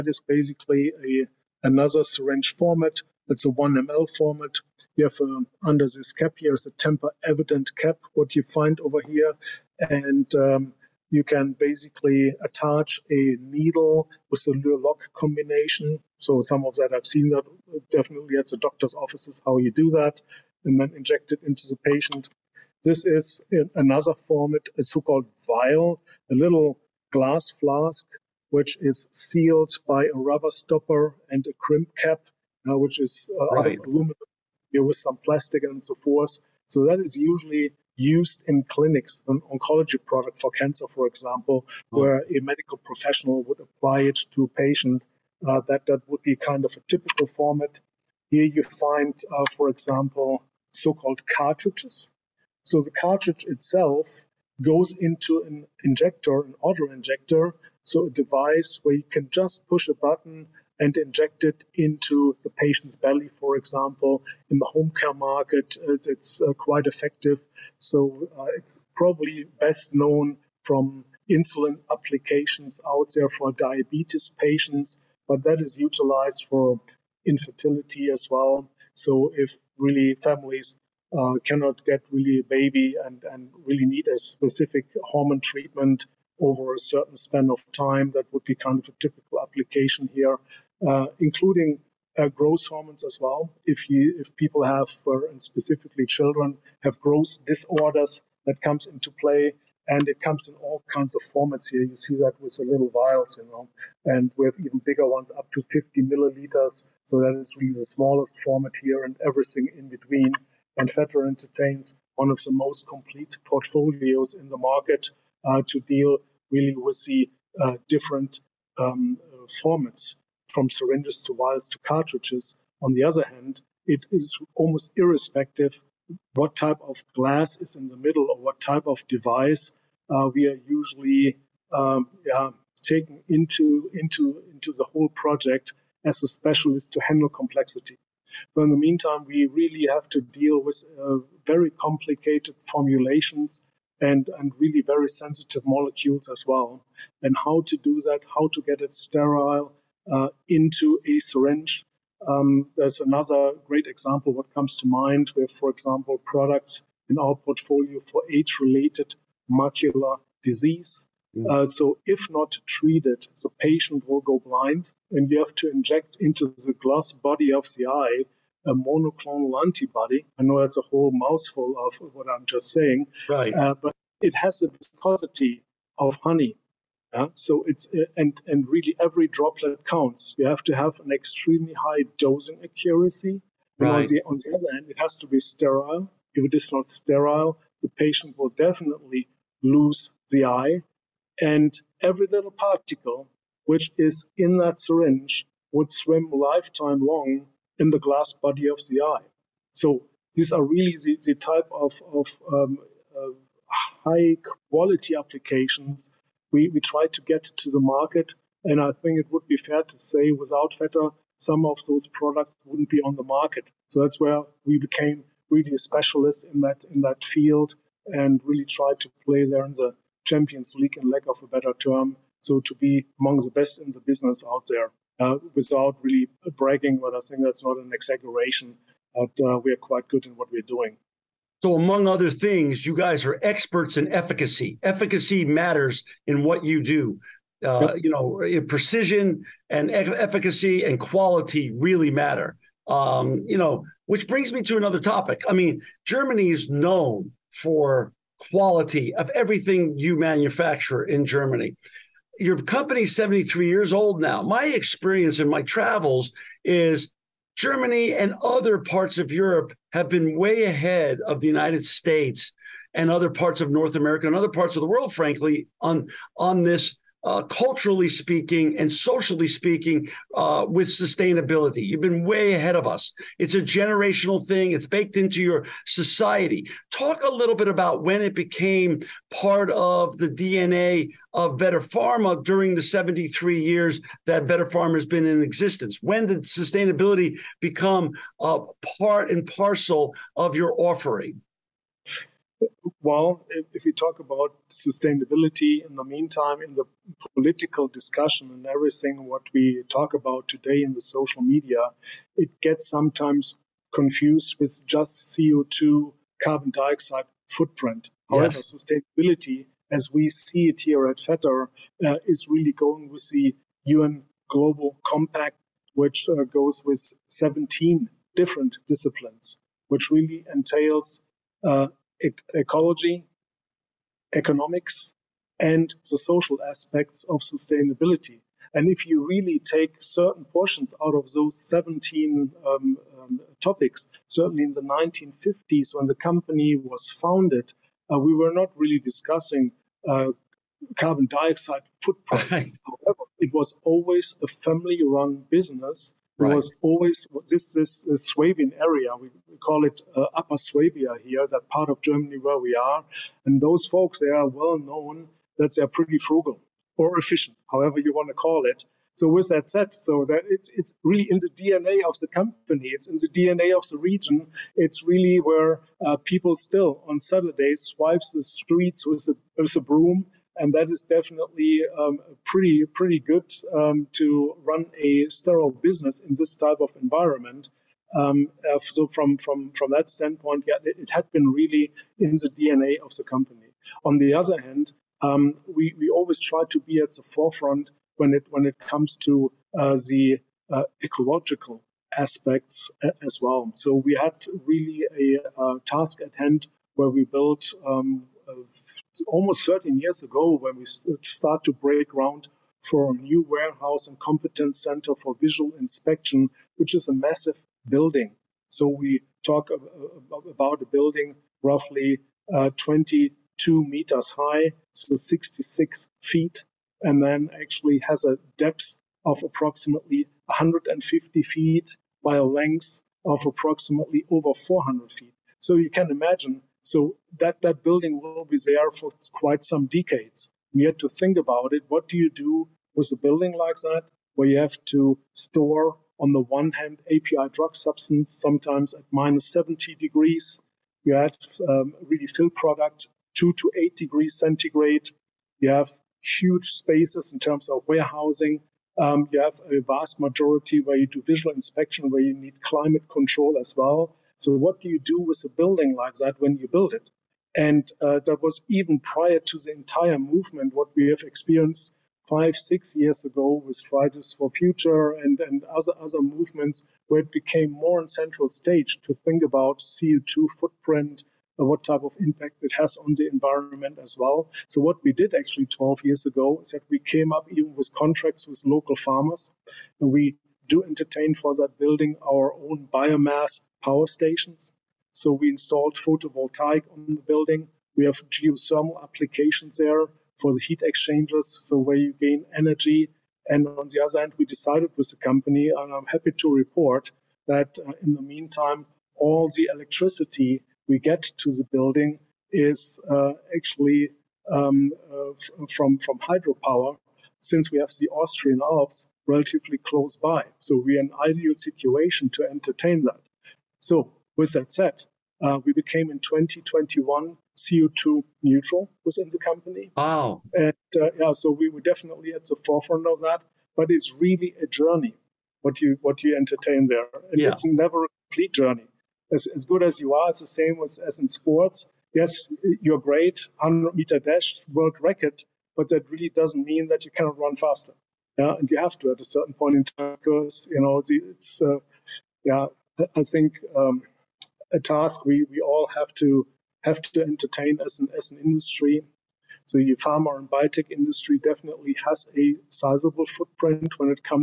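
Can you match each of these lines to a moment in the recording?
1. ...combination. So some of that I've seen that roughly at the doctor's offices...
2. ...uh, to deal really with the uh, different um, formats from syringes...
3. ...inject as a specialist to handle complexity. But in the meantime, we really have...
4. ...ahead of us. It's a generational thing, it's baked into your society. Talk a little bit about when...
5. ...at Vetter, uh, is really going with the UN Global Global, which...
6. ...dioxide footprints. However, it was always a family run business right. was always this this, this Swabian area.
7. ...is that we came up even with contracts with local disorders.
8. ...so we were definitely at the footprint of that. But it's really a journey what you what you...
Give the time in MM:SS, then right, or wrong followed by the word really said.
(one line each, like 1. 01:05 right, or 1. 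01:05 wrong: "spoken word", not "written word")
1. 00:15 wrong: "definitely", not "roughly"
2. 01:55 right
3. 02:15 wrong: "project", not "inject"
4. 04:32 right
5. 05:11 wrong: "Compact", not "Global"
6. 05:41 right
7. 07:56 wrong: "farmers", not "disorders"
8. 08:41 wrong: "forefront", not "footprint".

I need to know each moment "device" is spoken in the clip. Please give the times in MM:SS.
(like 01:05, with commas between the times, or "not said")
00:58, 02:09.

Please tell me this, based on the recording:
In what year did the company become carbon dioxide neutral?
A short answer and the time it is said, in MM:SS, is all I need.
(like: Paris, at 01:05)
2021, at 08:36.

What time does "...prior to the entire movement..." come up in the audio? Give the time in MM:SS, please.
07:38.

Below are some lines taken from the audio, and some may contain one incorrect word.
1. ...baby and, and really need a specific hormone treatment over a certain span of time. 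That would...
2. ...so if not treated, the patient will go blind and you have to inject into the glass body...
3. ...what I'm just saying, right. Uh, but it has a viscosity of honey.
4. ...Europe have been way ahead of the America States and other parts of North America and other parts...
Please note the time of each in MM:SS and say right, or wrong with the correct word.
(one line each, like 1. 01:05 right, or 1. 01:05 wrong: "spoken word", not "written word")
1. 01:22 right
2. 02:41 right
3. 02:52 right
4. 04:19 wrong: "United", not "America".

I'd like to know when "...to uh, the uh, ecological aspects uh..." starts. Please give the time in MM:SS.
06:29.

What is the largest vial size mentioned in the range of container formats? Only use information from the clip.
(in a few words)
50 milliliters.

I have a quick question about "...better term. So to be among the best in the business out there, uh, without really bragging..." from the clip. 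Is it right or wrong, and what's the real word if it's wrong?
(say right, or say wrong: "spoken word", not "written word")
right.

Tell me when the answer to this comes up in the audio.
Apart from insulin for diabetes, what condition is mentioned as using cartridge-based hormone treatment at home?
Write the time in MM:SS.
01:17.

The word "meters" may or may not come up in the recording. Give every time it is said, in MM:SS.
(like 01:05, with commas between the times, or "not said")
06:53, 08:53.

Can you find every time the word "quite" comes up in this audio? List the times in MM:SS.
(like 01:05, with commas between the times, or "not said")
01:06, 03:49, 07:09.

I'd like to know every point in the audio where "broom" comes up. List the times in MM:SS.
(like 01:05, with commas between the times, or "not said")
06:09.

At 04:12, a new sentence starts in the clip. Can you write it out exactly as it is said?
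Your company's 73 years old now.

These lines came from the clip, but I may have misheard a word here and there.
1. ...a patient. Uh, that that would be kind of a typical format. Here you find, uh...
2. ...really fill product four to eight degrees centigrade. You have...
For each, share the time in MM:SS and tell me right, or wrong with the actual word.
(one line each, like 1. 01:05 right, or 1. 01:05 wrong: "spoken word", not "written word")
1. 00:44 right
2. 07:22 wrong: "two", not "four".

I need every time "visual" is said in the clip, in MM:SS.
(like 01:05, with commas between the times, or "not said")
06:45, 07:31.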